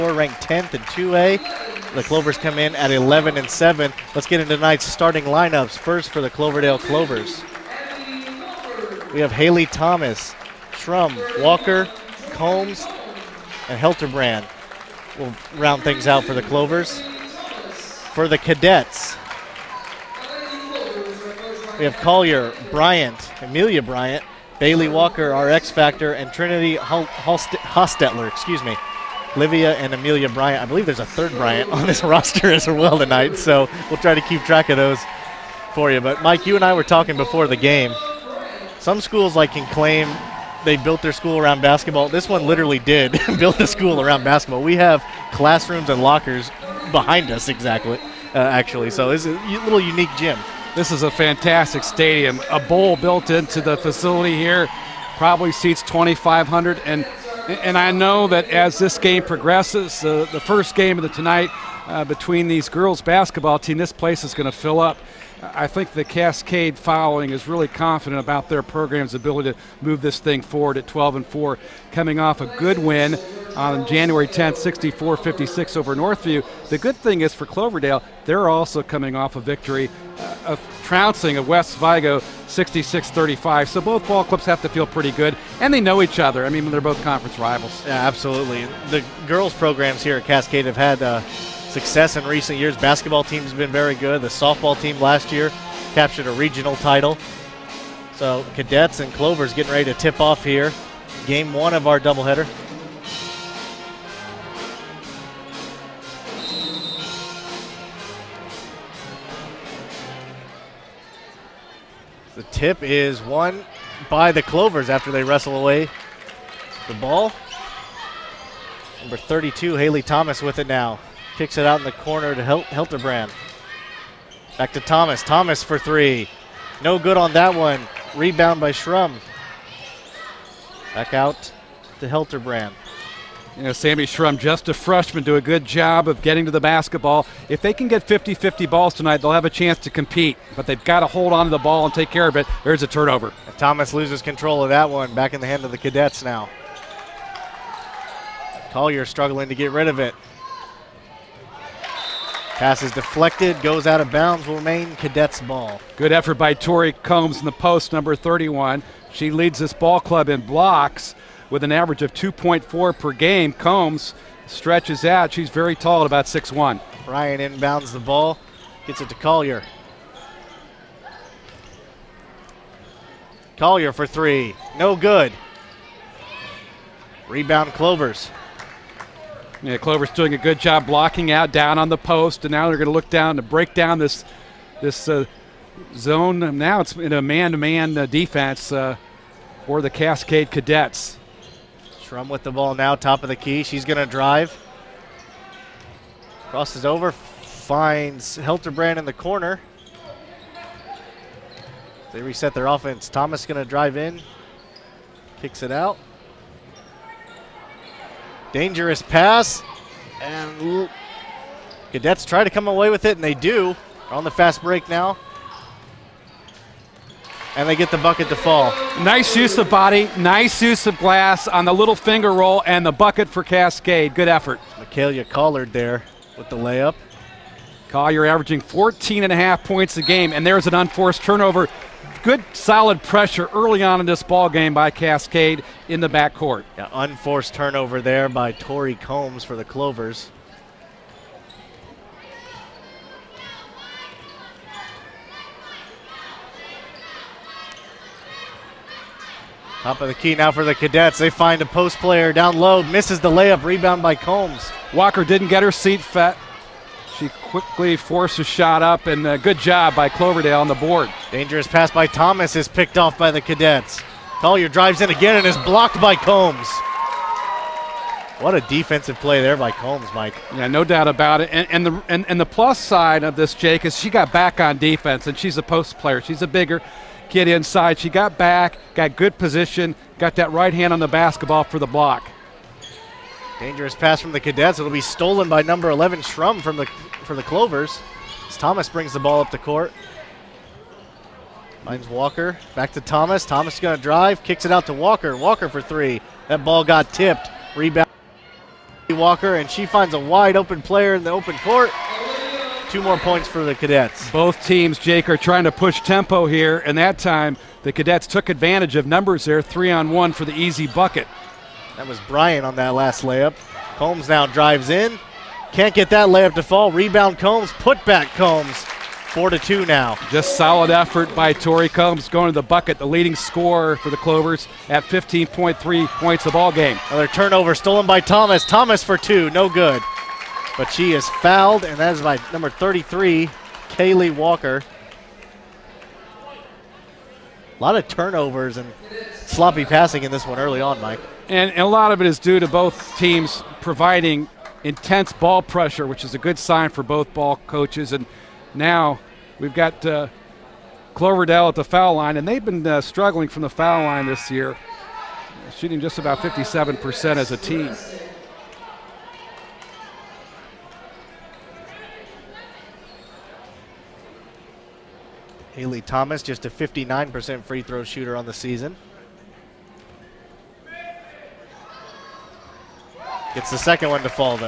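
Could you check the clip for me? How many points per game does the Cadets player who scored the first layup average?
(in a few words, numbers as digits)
14.5.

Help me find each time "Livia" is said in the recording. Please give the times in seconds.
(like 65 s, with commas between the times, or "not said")
29 s.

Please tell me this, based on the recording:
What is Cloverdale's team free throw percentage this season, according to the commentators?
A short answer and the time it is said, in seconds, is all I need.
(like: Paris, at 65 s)
57%, at 356 s.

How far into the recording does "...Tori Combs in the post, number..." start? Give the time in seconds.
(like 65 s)
156 s.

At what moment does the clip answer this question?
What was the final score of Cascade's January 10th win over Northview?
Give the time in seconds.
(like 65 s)
74 s.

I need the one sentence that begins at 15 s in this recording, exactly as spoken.
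We'll round things out for the Clovers.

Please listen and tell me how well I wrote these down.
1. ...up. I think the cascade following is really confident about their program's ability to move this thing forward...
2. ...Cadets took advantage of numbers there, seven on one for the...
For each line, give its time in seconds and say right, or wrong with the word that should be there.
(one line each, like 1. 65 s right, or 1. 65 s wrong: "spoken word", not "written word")
1. 64 s right
2. 307 s wrong: "three", not "seven".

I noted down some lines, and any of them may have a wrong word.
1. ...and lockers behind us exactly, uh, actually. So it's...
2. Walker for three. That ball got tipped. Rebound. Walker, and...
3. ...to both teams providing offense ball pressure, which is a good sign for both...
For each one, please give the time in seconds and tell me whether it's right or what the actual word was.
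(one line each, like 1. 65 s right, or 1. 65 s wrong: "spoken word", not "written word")
1. 45 s right
2. 295 s right
3. 342 s wrong: "intense", not "offense".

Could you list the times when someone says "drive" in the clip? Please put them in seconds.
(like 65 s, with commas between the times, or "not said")
194 s, 203 s, 264 s, 294 s, 314 s.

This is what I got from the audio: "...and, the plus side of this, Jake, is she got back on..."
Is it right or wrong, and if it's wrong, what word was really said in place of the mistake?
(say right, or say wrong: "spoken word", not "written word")
right.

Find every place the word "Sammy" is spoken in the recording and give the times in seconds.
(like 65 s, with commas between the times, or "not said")
133 s.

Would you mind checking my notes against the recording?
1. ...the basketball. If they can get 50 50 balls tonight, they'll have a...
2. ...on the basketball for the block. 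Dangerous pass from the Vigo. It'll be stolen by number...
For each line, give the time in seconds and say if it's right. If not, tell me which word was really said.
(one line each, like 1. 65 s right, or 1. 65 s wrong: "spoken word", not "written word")
1. 136 s right
2. 280 s wrong: "Cadets", not "Vigo".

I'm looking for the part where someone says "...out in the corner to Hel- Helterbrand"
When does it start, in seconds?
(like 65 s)
121 s.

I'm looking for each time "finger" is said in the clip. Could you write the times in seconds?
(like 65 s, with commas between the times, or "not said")
221 s.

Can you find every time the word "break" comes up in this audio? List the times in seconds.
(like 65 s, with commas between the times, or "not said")
183 s, 214 s.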